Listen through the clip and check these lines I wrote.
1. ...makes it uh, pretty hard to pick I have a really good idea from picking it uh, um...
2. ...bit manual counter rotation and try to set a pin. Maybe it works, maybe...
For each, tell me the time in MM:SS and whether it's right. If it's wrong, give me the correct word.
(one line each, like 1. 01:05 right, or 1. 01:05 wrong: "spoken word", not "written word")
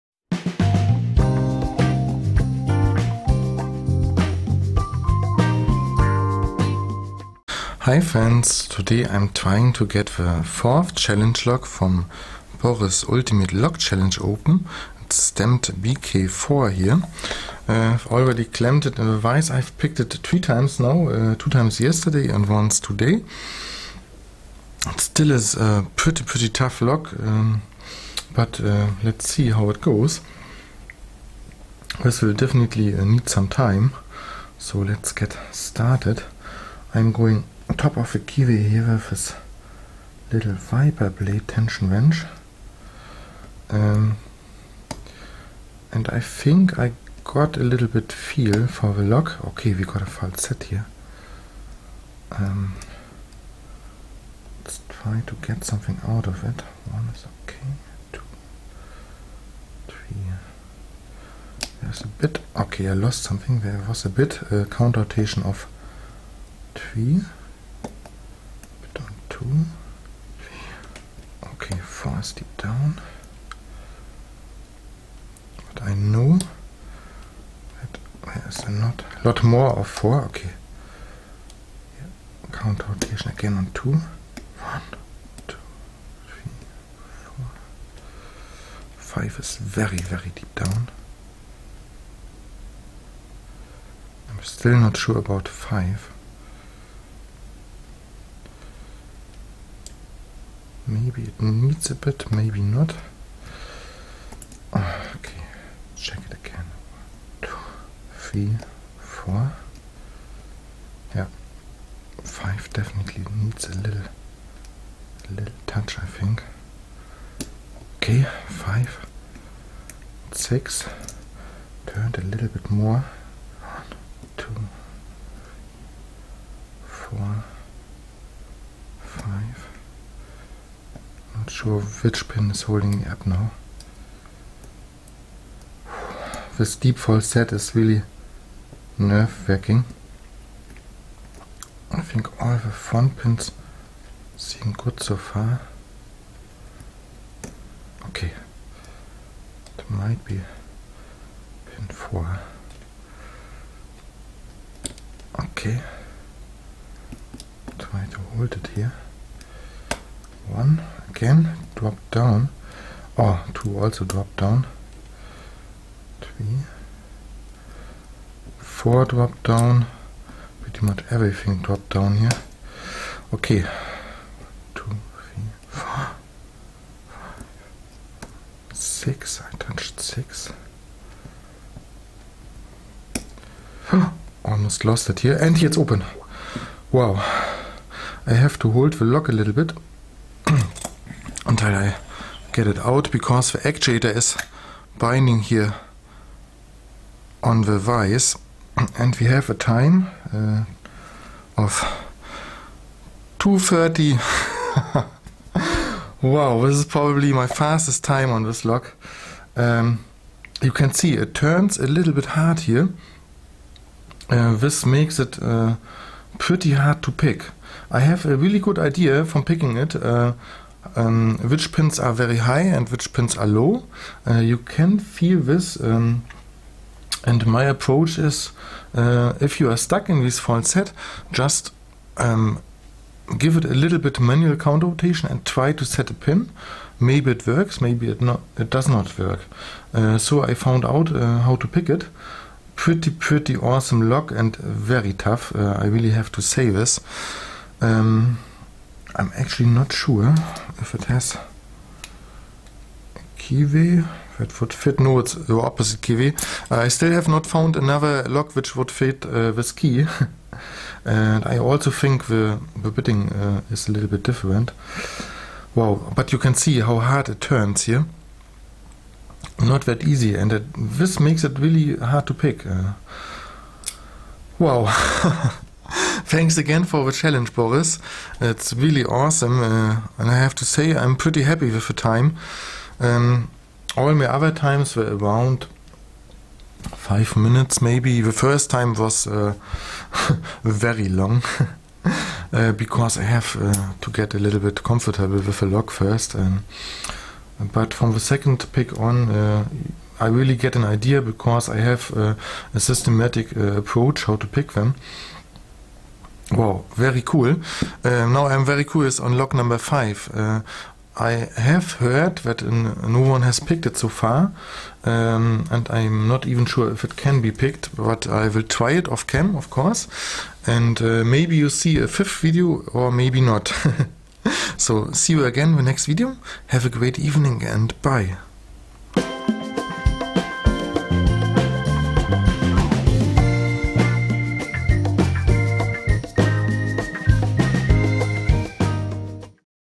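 1. 03:34 right
2. 03:53 right.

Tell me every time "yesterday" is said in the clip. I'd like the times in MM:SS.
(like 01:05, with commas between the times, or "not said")
00:21.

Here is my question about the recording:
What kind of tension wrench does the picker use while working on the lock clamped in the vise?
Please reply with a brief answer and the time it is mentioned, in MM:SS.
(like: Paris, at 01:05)
viper blade, at 00:40.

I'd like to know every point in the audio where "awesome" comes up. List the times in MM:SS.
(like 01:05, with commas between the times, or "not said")
04:03, 04:39.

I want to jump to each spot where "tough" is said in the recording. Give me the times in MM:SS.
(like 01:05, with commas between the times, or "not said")
00:26, 04:05.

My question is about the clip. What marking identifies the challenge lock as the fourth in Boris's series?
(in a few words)
BK4.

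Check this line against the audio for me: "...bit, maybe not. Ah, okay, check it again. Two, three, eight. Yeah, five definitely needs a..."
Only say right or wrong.
wrong.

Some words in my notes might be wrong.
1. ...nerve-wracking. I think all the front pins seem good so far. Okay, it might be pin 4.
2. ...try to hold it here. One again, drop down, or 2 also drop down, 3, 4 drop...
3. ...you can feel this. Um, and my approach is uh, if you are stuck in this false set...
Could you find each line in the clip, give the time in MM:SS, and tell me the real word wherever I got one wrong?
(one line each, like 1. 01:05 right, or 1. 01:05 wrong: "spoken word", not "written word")
1. 02:18 right
2. 02:37 right
3. 03:44 right.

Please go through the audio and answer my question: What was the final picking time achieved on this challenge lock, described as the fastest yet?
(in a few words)
2:30.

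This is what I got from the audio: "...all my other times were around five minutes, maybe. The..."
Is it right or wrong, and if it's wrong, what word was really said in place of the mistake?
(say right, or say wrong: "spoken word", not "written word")
right.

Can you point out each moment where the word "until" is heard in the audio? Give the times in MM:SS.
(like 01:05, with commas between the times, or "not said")
03:11.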